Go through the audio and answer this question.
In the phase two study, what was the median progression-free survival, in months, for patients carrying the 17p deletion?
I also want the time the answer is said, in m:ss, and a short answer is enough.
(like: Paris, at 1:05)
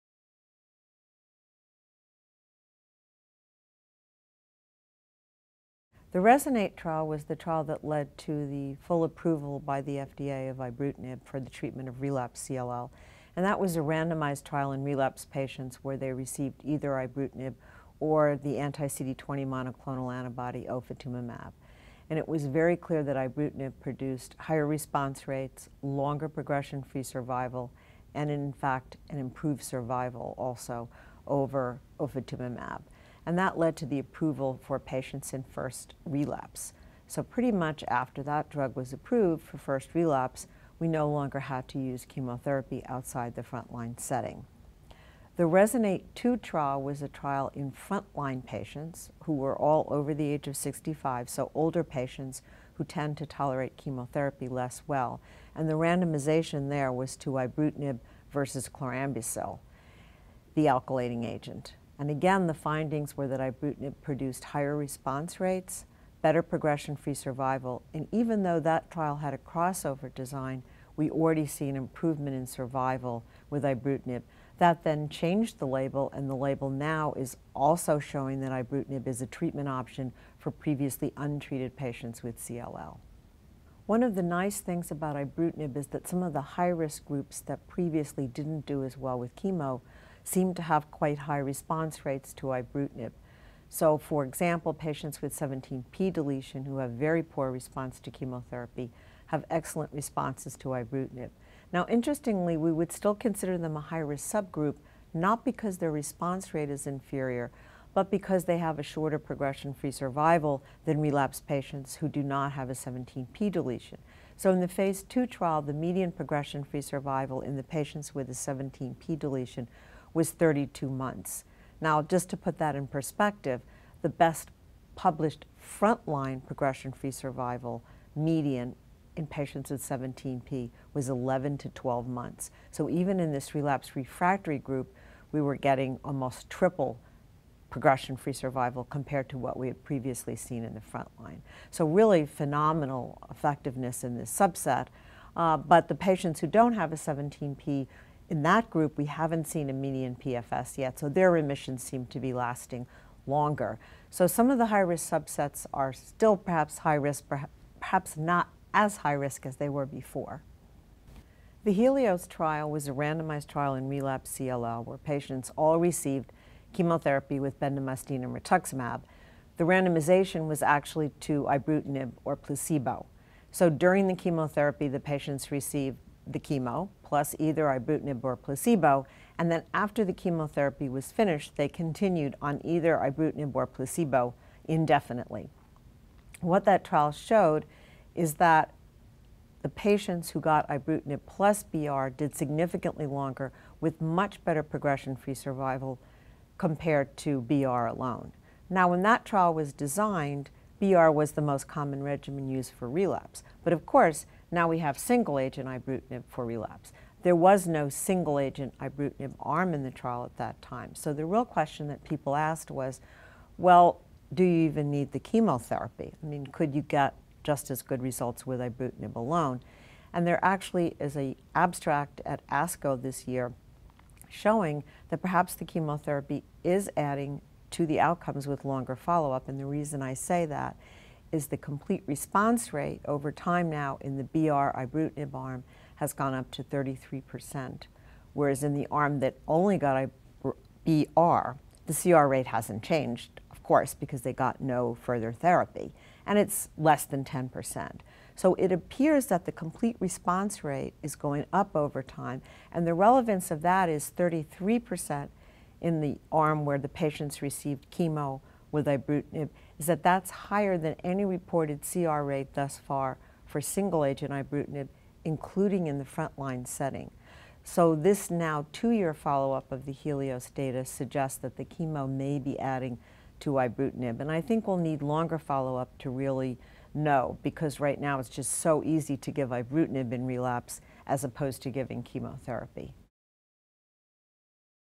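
32, at 2:00.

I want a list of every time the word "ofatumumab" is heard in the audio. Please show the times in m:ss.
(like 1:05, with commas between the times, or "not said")
0:20, 0:32.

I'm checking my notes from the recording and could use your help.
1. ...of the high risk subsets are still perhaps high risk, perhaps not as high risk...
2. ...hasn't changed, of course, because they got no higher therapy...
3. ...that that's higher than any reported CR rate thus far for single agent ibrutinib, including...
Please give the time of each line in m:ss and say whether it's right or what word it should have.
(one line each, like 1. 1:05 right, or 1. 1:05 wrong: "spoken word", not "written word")
1. 2:34 right
2. 4:02 wrong: "further", not "higher"
3. 4:19 right.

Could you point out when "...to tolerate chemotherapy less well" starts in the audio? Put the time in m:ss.
0:53.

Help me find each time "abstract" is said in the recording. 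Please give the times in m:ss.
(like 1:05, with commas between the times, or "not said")
3:41.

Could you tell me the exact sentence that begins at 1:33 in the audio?
So for example, patients with 17p deletion who have very poor response to chemotherapy have excellent responses to ibrutinib.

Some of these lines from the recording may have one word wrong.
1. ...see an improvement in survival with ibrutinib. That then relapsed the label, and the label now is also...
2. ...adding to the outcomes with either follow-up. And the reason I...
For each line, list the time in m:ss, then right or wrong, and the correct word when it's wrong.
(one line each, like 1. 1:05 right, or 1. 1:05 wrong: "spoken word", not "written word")
1. 1:11 wrong: "changed", not "relapsed"
2. 3:46 wrong: "longer", not "either".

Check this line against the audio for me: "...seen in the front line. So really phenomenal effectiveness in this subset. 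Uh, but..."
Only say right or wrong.
right.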